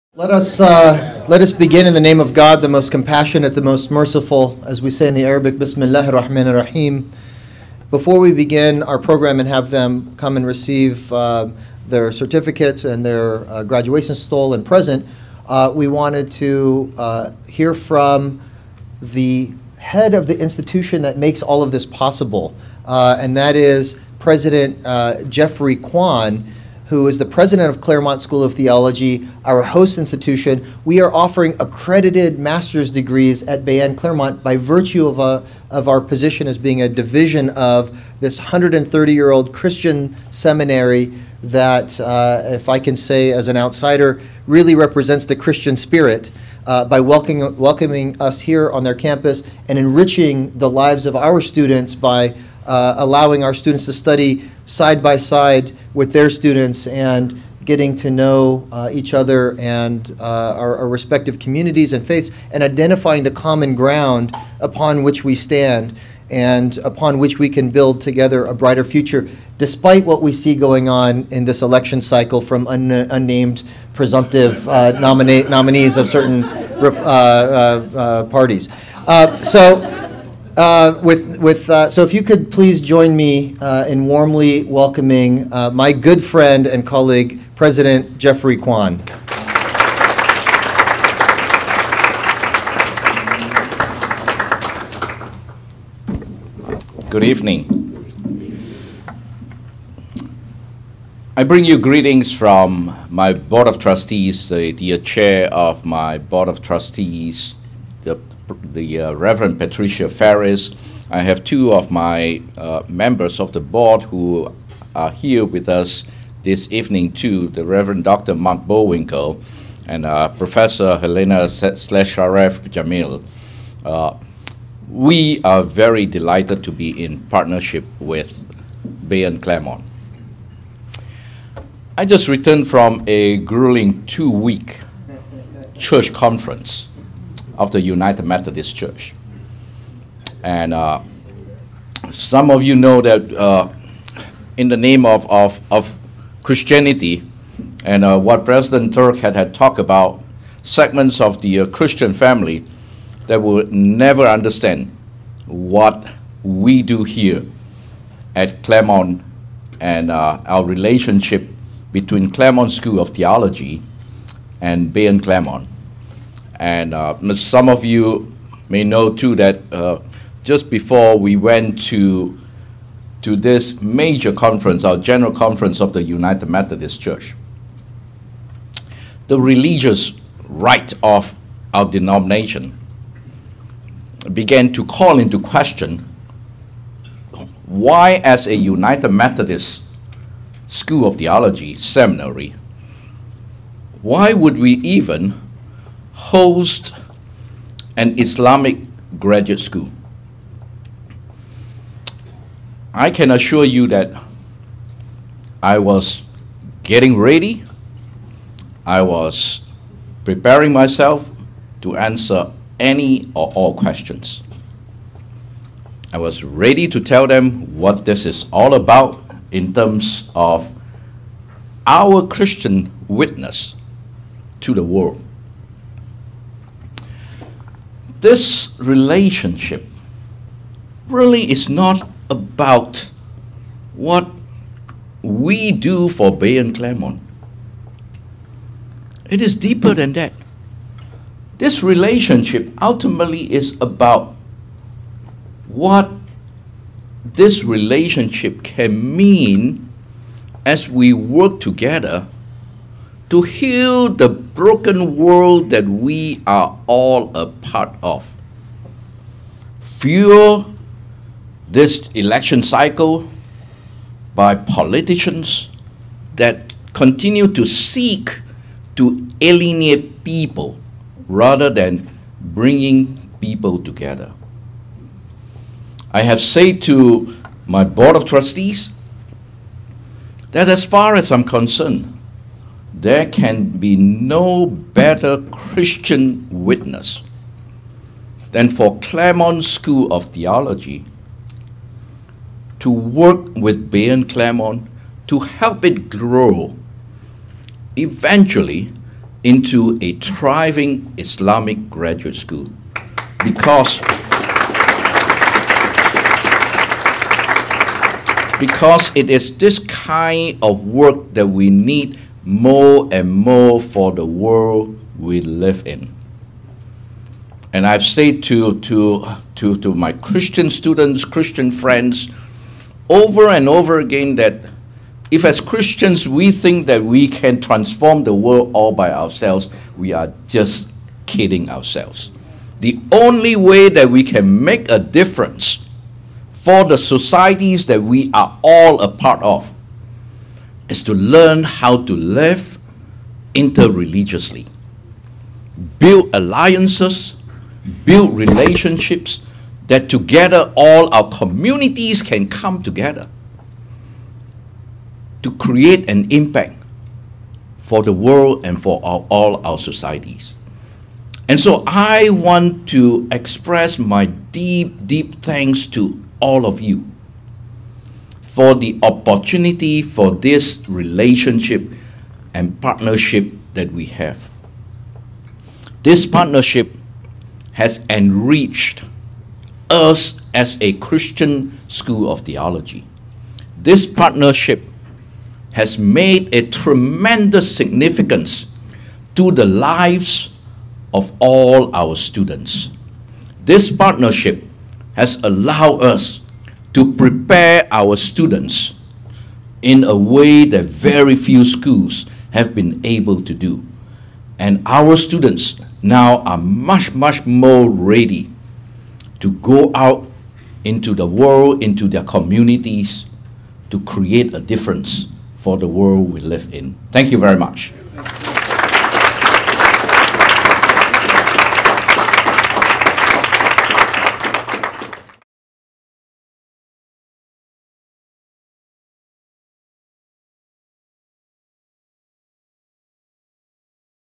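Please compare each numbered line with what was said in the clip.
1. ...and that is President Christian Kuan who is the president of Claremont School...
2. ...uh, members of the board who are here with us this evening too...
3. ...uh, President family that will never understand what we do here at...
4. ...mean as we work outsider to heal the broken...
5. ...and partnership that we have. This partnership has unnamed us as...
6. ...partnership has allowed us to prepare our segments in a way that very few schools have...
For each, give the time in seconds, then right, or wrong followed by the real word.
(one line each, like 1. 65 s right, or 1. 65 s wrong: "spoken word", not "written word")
1. 23 s wrong: "Jeffrey", not "Christian"
2. 112 s right
3. 151 s wrong: "Christian", not "President"
4. 249 s wrong: "together", not "outsider"
5. 372 s wrong: "enriched", not "unnamed"
6. 393 s wrong: "students", not "segments".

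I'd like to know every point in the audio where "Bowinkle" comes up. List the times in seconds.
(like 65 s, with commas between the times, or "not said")
118 s.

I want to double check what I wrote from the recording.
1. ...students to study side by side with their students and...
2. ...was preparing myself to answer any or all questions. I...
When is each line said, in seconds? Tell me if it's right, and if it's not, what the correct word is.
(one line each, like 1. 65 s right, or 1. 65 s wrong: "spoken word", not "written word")
1. 53 s right
2. 209 s right.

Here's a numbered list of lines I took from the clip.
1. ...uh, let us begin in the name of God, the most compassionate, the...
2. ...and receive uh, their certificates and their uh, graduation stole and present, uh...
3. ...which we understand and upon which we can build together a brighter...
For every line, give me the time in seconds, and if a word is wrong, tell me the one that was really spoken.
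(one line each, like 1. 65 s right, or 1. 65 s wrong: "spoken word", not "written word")
1. 0 s right
2. 10 s right
3. 65 s wrong: "stand", not "understand".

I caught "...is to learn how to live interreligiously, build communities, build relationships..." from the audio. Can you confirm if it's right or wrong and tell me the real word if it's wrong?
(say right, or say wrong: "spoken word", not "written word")
wrong: "alliances", not "communities".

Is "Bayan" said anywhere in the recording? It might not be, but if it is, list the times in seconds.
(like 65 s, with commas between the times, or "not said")
33 s, 129 s, 164 s, 236 s, 293 s.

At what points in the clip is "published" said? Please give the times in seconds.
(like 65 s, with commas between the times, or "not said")
not said.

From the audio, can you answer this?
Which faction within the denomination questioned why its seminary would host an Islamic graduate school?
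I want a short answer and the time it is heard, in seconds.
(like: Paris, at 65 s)
the religious right, at 179 s.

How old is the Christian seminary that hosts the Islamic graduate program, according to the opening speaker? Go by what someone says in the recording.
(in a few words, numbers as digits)
130 years.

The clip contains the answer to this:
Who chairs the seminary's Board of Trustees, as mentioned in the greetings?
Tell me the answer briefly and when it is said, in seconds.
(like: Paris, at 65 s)
Reverend Patricia Farris, at 109 s.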